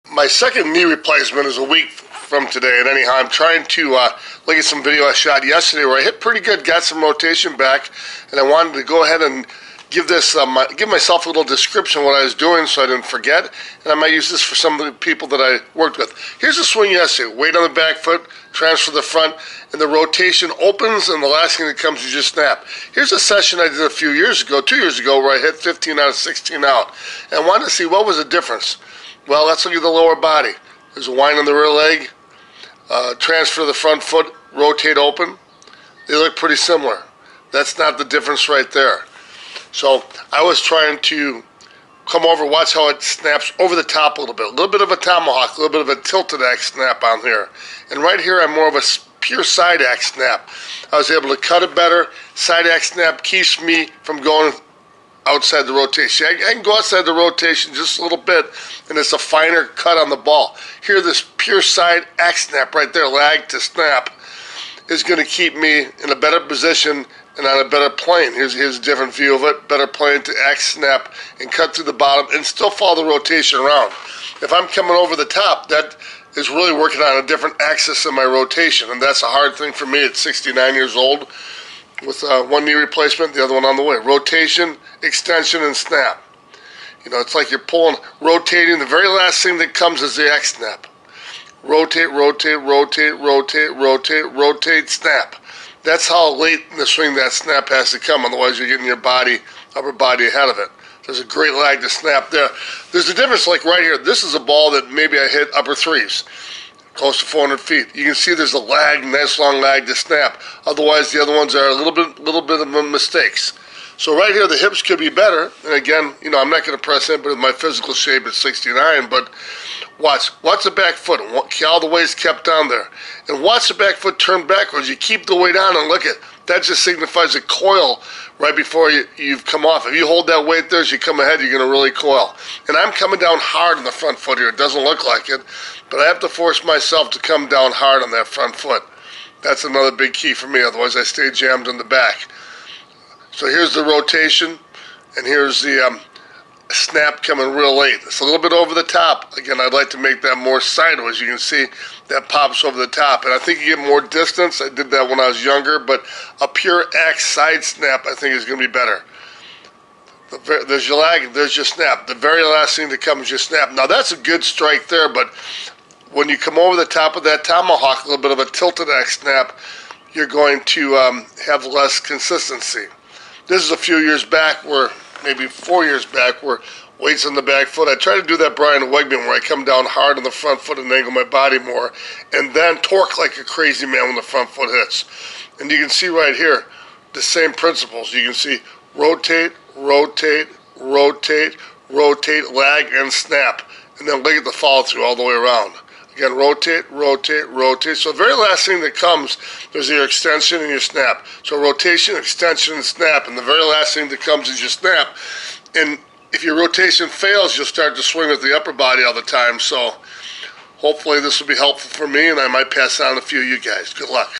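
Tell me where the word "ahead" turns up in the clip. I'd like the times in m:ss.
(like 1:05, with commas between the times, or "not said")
0:09, 1:40, 2:11.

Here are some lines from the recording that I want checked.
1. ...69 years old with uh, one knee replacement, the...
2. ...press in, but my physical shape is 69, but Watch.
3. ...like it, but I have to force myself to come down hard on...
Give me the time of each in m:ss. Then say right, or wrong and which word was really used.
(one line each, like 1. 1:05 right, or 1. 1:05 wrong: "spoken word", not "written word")
1. 1:20 right
2. 1:56 right
3. 2:15 right.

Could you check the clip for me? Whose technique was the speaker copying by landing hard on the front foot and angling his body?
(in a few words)
Brian Wegman.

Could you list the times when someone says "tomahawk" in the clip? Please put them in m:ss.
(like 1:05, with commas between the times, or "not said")
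0:44, 2:47.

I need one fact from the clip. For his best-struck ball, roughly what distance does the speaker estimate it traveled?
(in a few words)
close to 400 feet.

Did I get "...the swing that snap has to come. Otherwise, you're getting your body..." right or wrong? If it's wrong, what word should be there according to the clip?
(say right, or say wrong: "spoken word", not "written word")
right.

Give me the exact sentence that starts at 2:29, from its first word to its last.
Again, I'd like to make that more sideways.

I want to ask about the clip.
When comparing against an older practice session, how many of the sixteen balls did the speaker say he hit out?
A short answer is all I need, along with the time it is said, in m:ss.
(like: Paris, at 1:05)
15, at 0:25.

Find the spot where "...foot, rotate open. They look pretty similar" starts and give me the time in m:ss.
0:34.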